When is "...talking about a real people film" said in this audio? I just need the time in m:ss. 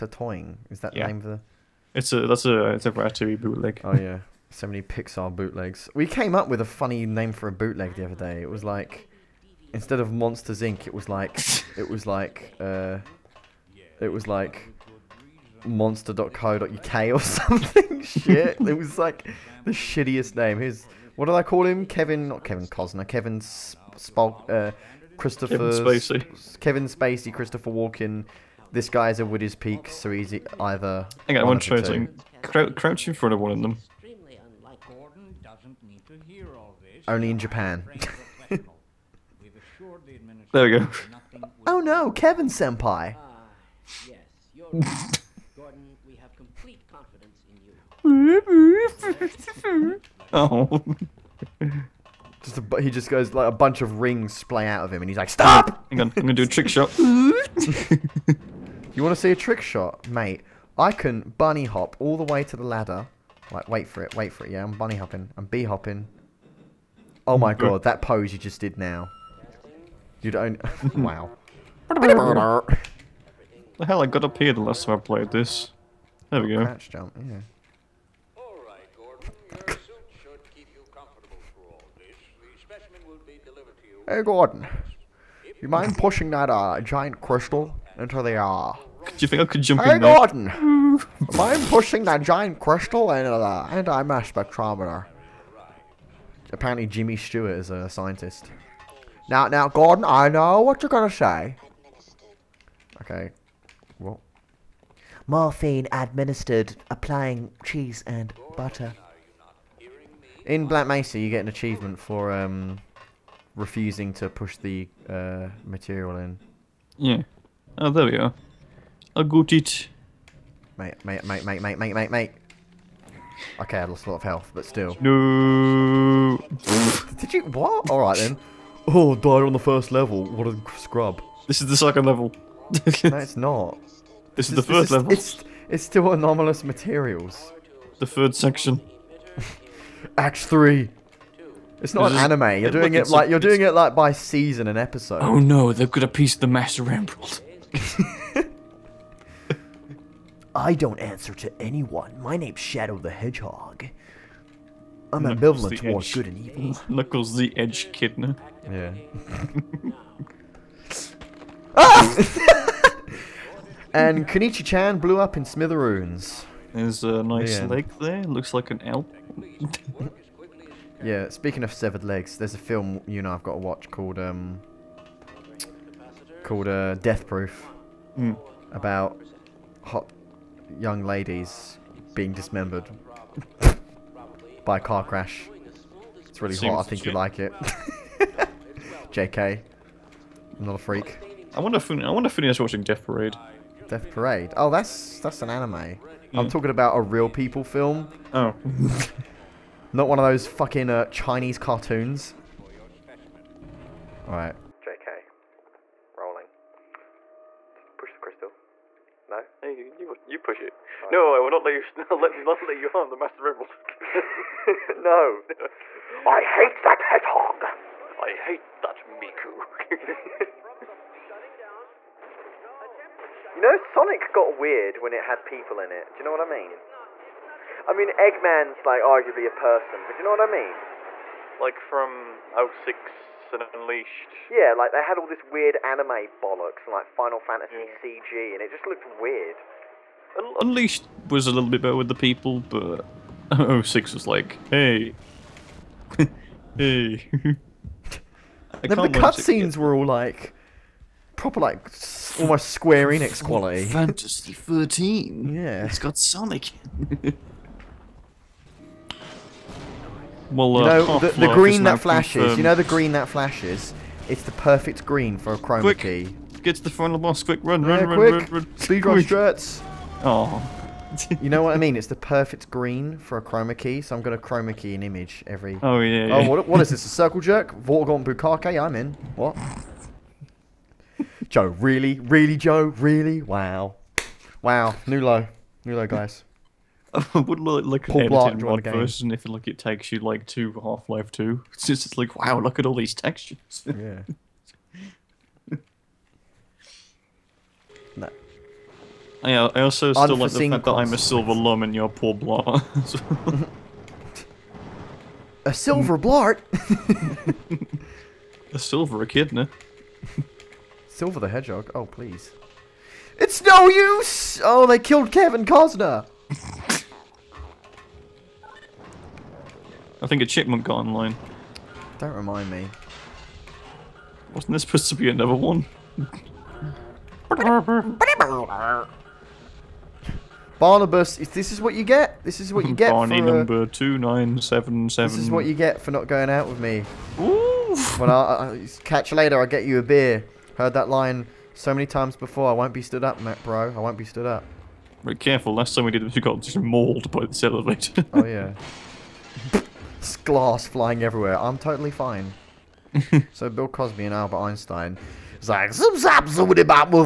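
3:16.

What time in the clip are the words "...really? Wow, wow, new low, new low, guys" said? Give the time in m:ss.
4:42.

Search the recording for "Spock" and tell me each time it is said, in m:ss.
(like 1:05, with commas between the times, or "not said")
0:23.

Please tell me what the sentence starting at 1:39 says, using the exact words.
Now, now, Gordon, I know what you're gonna say.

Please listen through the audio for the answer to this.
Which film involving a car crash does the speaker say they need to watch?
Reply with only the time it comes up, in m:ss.
2:56.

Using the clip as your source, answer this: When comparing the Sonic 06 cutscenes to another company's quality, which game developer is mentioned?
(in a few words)
Square Enix.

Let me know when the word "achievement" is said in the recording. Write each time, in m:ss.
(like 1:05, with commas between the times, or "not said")
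1:51.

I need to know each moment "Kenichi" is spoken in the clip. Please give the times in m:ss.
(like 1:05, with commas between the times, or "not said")
2:44.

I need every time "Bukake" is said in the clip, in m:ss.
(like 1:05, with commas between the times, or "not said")
4:38.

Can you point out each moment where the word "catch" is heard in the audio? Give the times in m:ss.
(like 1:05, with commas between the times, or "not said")
5:39.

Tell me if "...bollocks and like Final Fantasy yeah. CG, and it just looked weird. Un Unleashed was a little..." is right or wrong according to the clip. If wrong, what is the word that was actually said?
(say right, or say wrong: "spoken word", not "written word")
right.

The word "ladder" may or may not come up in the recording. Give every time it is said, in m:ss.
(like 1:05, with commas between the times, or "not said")
1:02.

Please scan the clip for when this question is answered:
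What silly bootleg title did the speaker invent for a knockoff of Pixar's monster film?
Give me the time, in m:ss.
0:15.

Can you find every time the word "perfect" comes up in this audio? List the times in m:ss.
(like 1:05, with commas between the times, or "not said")
4:24, 4:32.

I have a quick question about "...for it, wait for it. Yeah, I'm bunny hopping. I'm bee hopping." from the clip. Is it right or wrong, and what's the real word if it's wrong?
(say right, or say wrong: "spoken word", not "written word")
right.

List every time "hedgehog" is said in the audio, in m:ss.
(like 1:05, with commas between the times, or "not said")
2:33, 3:37, 5:11.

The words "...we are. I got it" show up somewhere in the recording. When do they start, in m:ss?
1:58.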